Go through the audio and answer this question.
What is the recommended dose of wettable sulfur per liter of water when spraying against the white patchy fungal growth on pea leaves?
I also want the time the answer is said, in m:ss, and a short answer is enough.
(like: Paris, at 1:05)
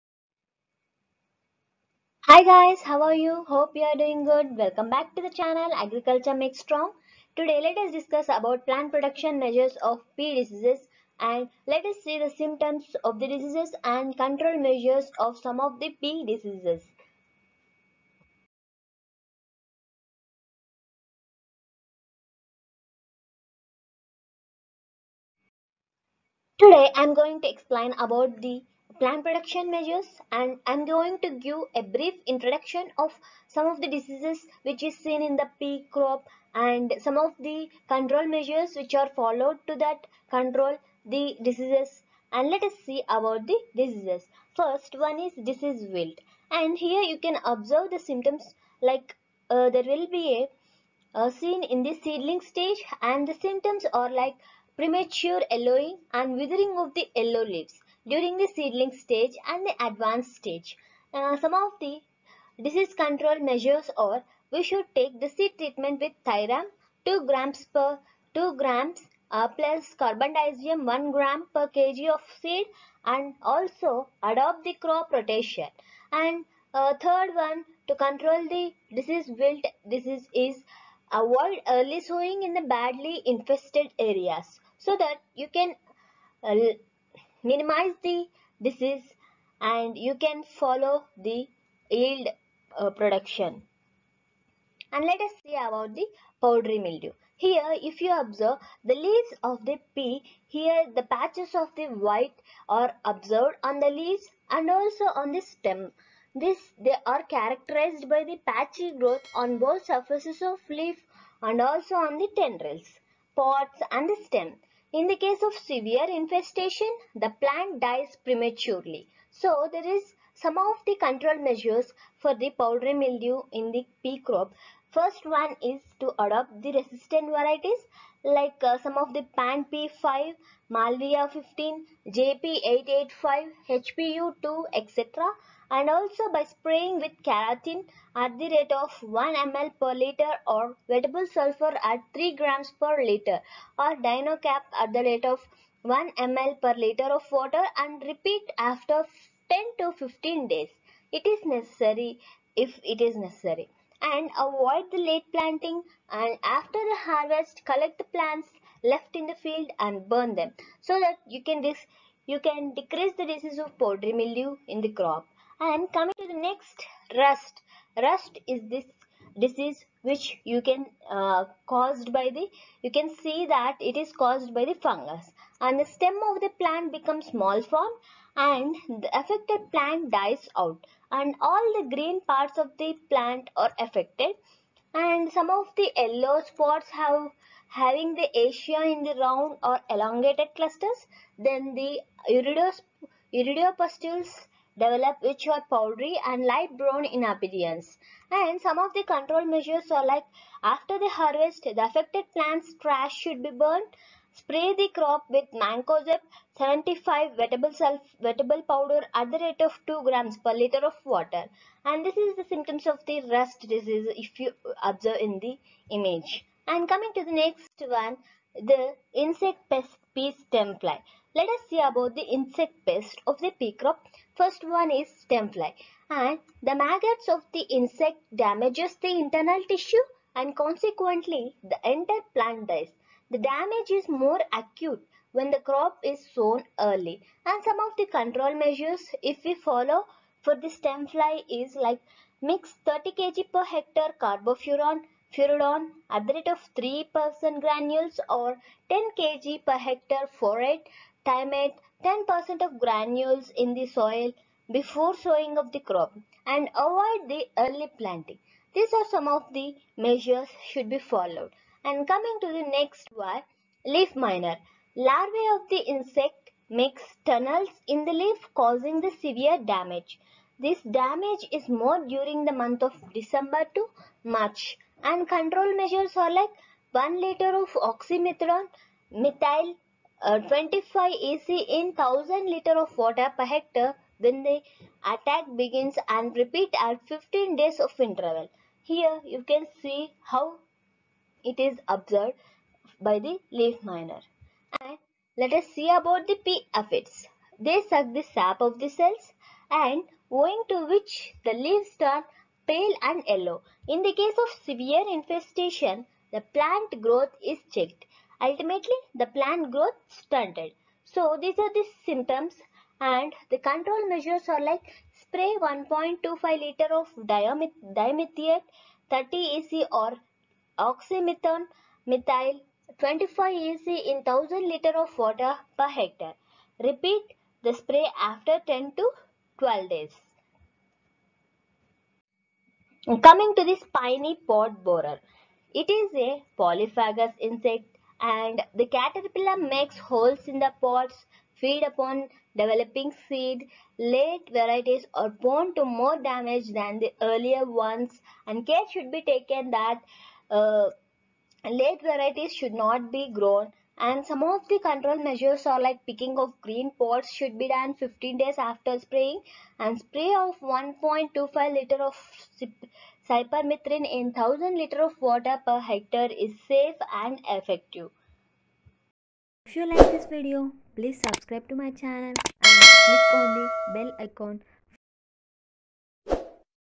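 3 grams per liter, at 2:22.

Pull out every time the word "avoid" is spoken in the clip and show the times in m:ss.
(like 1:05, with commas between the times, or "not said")
1:21, 2:34, 4:16.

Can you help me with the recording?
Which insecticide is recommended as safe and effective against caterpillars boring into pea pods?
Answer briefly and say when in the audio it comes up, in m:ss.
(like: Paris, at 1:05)
cypermethrin, at 6:03.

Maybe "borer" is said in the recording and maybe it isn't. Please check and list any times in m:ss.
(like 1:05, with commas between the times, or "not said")
5:34.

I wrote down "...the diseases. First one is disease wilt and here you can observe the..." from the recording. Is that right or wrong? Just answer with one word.
right.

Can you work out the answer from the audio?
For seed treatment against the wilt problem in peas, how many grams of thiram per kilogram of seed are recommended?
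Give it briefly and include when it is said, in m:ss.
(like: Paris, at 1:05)
2 grams, at 1:06.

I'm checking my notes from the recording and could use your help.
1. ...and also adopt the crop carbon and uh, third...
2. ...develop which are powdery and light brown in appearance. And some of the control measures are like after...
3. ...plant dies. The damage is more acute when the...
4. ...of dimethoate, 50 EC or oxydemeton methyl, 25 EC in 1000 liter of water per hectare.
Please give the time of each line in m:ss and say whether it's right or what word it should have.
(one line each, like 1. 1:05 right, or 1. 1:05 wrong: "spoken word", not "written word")
1. 1:13 wrong: "rotation", not "carbon"
2. 3:14 right
3. 3:52 right
4. 5:16 wrong: "30", not "50".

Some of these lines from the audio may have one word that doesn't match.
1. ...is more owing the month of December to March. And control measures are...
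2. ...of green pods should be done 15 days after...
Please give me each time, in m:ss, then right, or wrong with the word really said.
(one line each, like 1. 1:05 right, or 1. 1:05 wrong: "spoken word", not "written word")
1. 4:31 wrong: "during", not "owing"
2. 5:56 right.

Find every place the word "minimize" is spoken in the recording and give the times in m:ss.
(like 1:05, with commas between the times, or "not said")
1:27.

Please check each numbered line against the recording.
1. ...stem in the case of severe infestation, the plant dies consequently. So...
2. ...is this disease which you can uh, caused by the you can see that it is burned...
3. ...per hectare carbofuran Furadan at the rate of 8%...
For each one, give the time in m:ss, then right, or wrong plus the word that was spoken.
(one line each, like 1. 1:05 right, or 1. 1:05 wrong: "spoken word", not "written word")
1. 1:54 wrong: "prematurely", not "consequently"
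2. 2:48 wrong: "caused", not "burned"
3. 4:03 wrong: "3", not "8".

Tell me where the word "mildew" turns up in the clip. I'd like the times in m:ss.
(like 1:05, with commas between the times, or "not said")
1:36, 2:02, 2:44.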